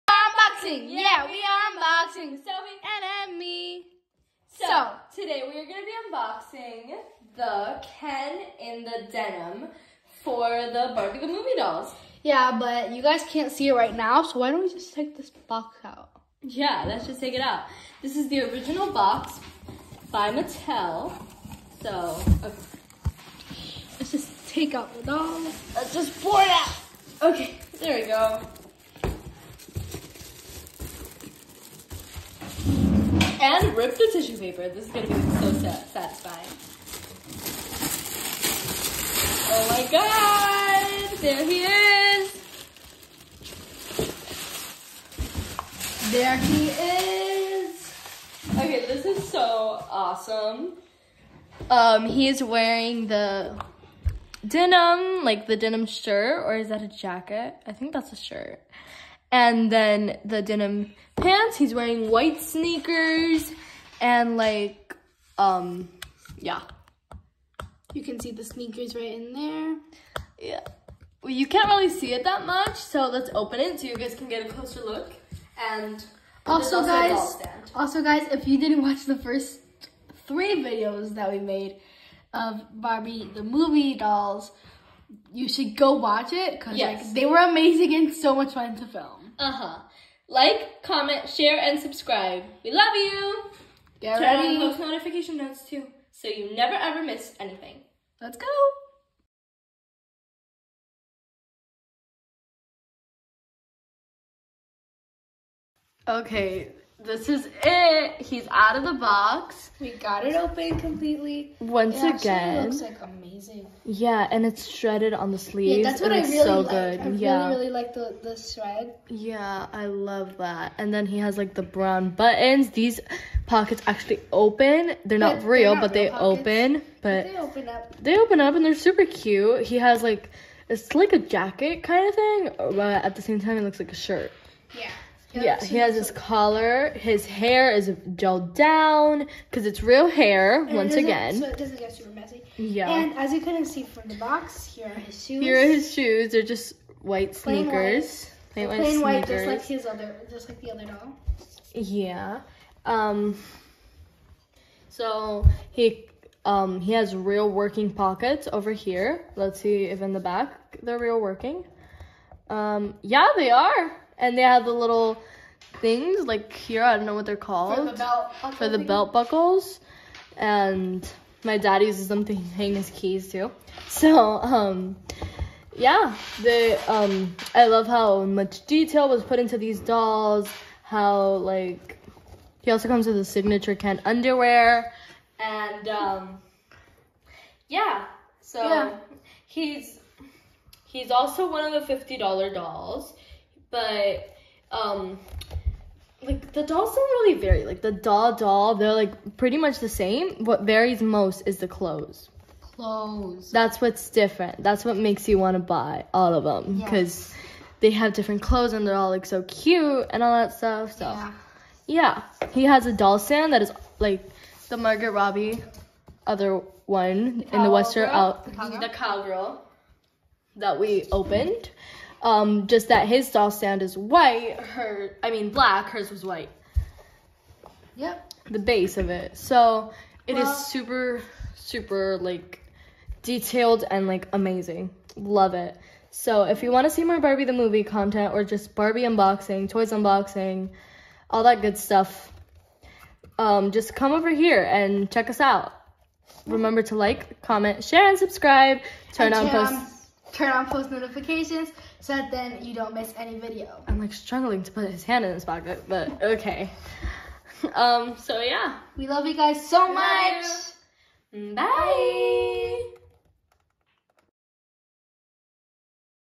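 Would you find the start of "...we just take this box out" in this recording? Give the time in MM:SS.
00:14.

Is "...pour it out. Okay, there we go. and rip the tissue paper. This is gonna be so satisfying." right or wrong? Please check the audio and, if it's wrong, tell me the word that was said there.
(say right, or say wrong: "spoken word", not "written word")
right.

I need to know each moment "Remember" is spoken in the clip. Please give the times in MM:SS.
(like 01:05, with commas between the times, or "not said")
04:06.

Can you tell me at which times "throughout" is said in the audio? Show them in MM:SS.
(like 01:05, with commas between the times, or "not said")
not said.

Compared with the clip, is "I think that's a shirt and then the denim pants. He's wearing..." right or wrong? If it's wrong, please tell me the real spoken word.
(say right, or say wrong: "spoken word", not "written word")
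right.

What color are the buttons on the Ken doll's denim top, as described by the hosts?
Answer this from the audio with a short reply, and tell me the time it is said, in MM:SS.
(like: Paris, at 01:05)
Brown, at 02:01.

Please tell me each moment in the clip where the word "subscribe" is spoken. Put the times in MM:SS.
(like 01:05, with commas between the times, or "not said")
01:31, 04:08.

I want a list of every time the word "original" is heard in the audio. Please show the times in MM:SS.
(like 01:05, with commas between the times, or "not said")
00:18.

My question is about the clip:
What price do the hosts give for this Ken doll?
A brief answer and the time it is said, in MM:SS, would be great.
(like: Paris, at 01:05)
$50, at 03:11.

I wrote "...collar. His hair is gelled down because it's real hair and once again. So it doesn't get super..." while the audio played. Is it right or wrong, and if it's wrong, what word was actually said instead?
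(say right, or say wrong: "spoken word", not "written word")
right.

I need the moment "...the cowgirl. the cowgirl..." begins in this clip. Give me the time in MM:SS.
03:38.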